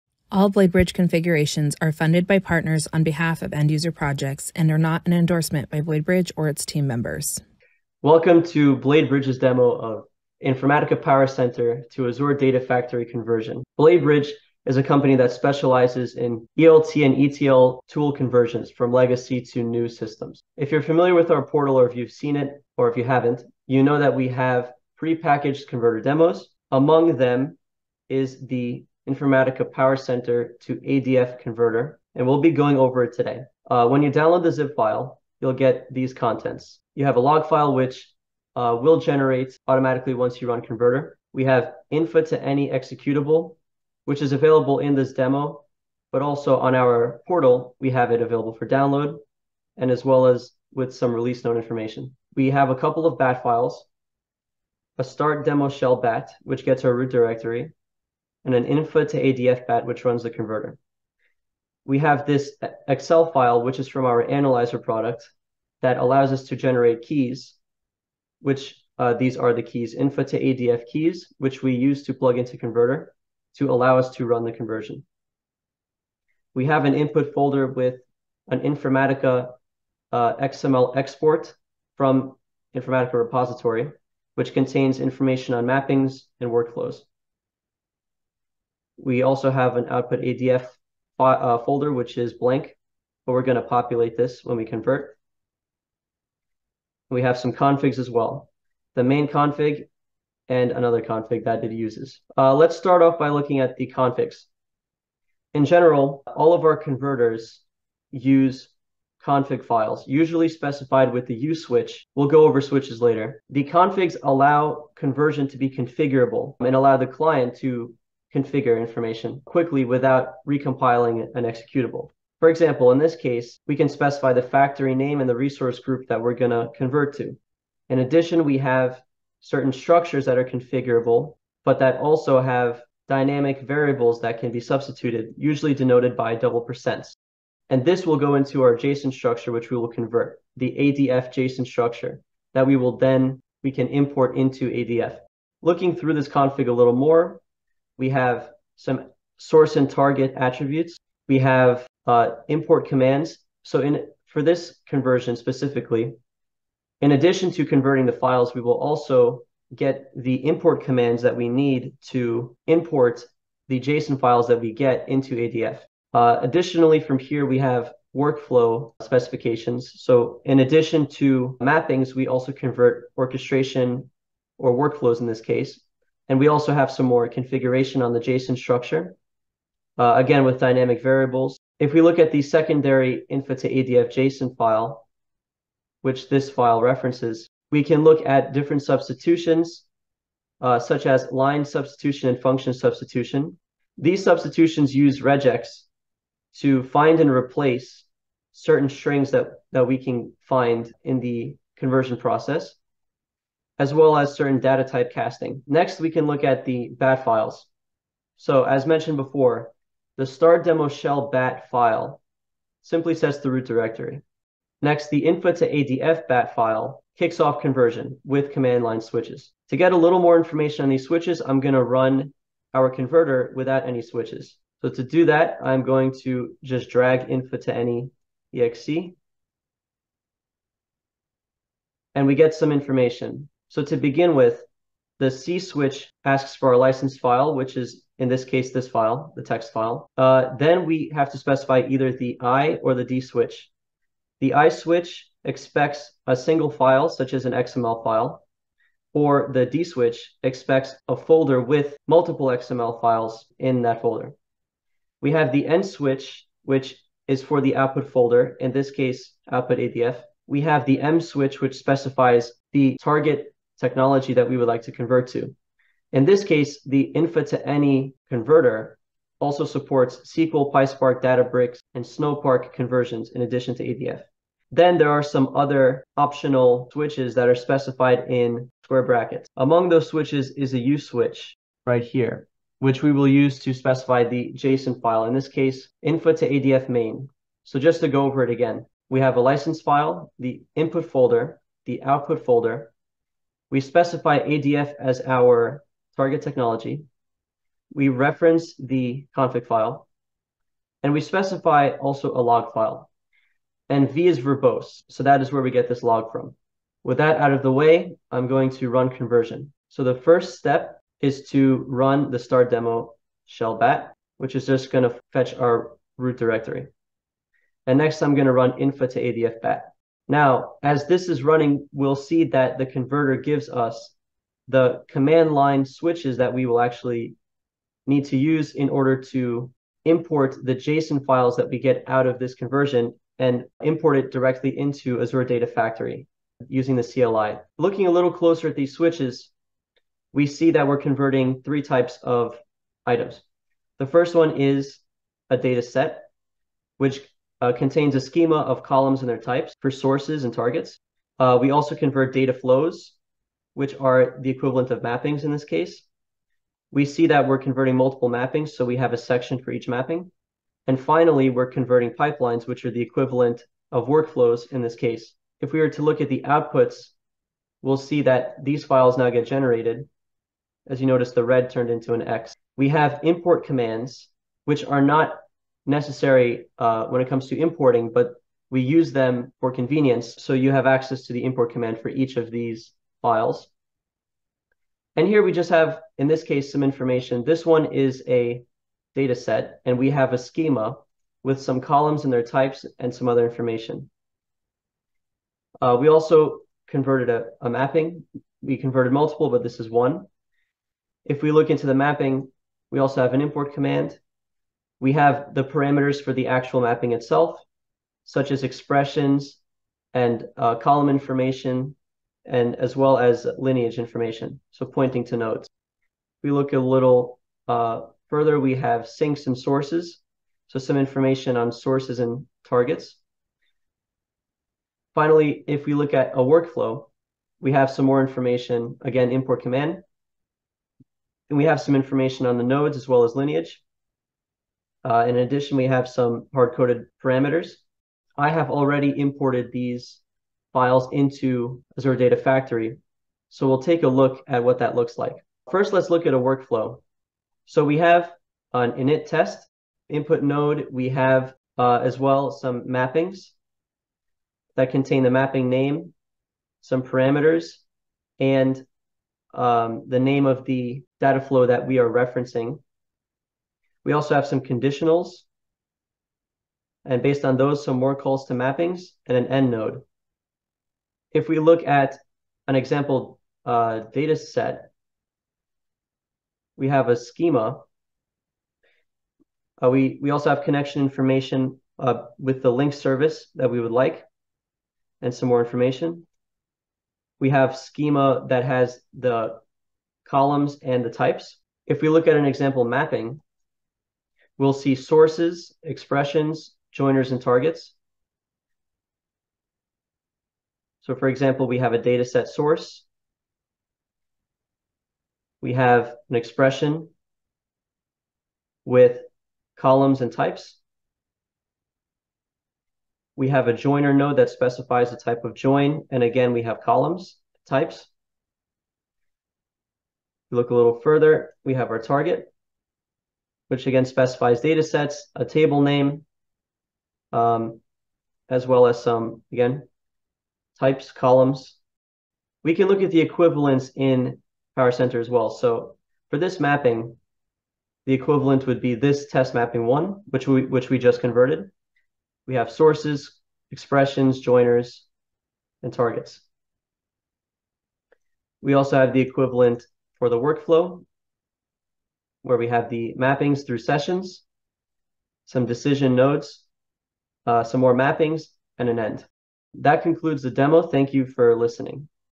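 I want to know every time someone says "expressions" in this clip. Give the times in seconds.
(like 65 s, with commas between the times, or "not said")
408 s, 495 s, 506 s, 543 s.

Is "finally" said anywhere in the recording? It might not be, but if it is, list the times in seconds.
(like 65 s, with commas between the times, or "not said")
360 s, 425 s.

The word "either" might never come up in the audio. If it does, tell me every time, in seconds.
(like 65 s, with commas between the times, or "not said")
241 s.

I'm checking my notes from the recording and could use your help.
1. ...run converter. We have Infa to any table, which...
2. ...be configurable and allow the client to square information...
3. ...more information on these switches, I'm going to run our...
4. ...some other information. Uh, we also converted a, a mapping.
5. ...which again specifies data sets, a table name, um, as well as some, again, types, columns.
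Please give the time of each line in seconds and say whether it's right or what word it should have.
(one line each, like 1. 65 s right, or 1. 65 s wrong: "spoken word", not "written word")
1. 40 s wrong: "executable", not "table"
2. 115 s wrong: "configure", not "square"
3. 220 s right
4. 393 s right
5. 523 s right.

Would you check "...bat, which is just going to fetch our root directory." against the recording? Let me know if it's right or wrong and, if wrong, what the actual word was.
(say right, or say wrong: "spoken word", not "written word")
right.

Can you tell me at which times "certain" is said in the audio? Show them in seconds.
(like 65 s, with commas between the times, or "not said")
129 s, 198 s, 204 s.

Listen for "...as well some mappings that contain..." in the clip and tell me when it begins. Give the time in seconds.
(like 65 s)
452 s.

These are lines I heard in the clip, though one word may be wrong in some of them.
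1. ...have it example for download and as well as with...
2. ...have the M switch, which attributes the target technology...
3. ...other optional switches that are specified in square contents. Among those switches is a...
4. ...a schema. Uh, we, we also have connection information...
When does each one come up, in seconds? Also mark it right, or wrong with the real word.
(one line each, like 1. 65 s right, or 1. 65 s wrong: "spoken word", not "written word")
1. 47 s wrong: "available", not "example"
2. 260 s wrong: "specifies", not "attributes"
3. 275 s wrong: "brackets", not "contents"
4. 477 s right.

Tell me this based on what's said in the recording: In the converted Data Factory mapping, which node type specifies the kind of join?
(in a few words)
joiner.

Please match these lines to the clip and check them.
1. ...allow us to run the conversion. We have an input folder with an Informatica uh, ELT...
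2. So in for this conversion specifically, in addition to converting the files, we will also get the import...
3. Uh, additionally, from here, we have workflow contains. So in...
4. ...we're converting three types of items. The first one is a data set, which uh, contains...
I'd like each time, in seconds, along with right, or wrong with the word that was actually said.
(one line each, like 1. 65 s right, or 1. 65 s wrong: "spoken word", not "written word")
1. 73 s wrong: "XML", not "ELT"
2. 153 s right
3. 166 s wrong: "specifications", not "contains"
4. 340 s right.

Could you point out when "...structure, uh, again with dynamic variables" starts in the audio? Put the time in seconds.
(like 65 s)
178 s.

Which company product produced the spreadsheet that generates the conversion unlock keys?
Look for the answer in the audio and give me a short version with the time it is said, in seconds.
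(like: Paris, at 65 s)
analyzer, at 64 s.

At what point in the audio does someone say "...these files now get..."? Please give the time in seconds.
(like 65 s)
368 s.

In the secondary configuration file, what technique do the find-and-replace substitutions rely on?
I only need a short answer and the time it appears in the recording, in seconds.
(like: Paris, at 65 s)
regex, at 195 s.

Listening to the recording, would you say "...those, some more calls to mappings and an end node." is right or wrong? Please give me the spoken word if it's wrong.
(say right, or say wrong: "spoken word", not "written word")
right.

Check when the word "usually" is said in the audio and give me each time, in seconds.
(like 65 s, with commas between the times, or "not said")
110 s, 135 s.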